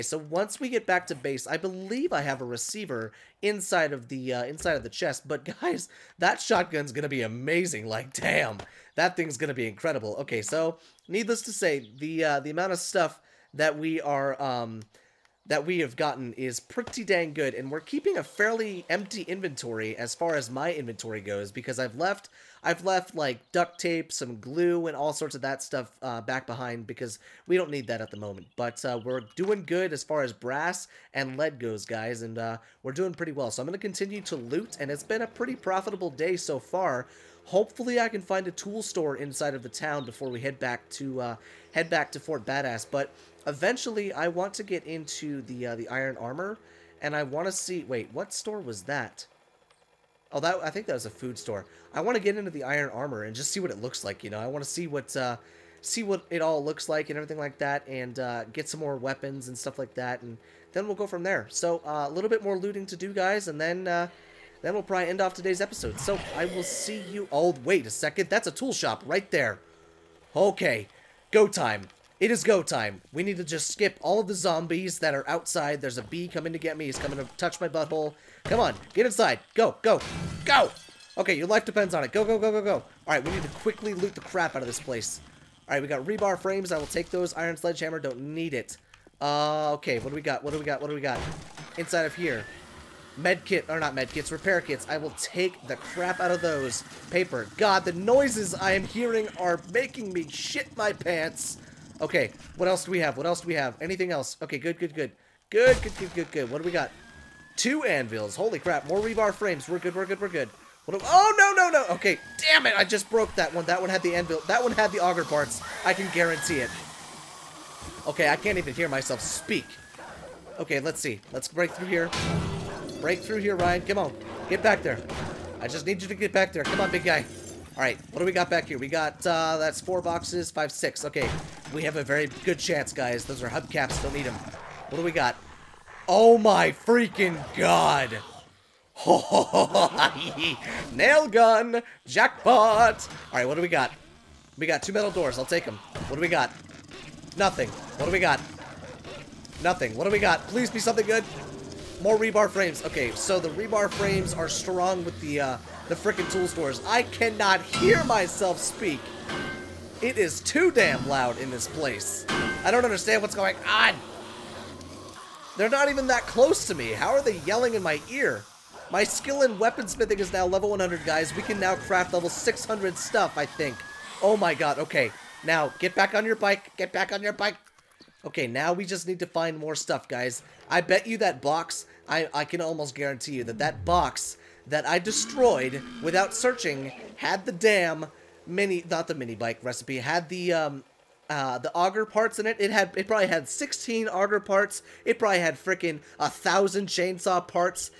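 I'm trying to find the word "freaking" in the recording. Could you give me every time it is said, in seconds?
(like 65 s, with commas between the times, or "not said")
136 s, 155 s.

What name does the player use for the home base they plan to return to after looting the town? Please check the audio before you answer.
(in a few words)
Fort Badass.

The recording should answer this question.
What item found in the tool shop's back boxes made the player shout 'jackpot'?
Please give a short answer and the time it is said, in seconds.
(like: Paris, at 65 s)
Nail gun, at 140 s.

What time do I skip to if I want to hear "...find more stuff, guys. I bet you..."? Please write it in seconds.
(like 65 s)
179 s.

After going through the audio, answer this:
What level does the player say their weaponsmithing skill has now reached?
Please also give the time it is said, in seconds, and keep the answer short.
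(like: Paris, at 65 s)
100, at 170 s.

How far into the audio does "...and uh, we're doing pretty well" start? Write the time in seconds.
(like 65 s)
32 s.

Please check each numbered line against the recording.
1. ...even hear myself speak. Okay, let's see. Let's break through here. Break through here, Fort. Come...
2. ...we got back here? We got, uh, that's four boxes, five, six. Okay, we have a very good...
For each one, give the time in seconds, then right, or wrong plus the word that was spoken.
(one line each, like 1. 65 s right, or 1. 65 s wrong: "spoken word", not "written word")
1. 118 s wrong: "Ryan", not "Fort"
2. 128 s right.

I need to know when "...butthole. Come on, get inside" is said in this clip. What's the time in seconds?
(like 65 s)
77 s.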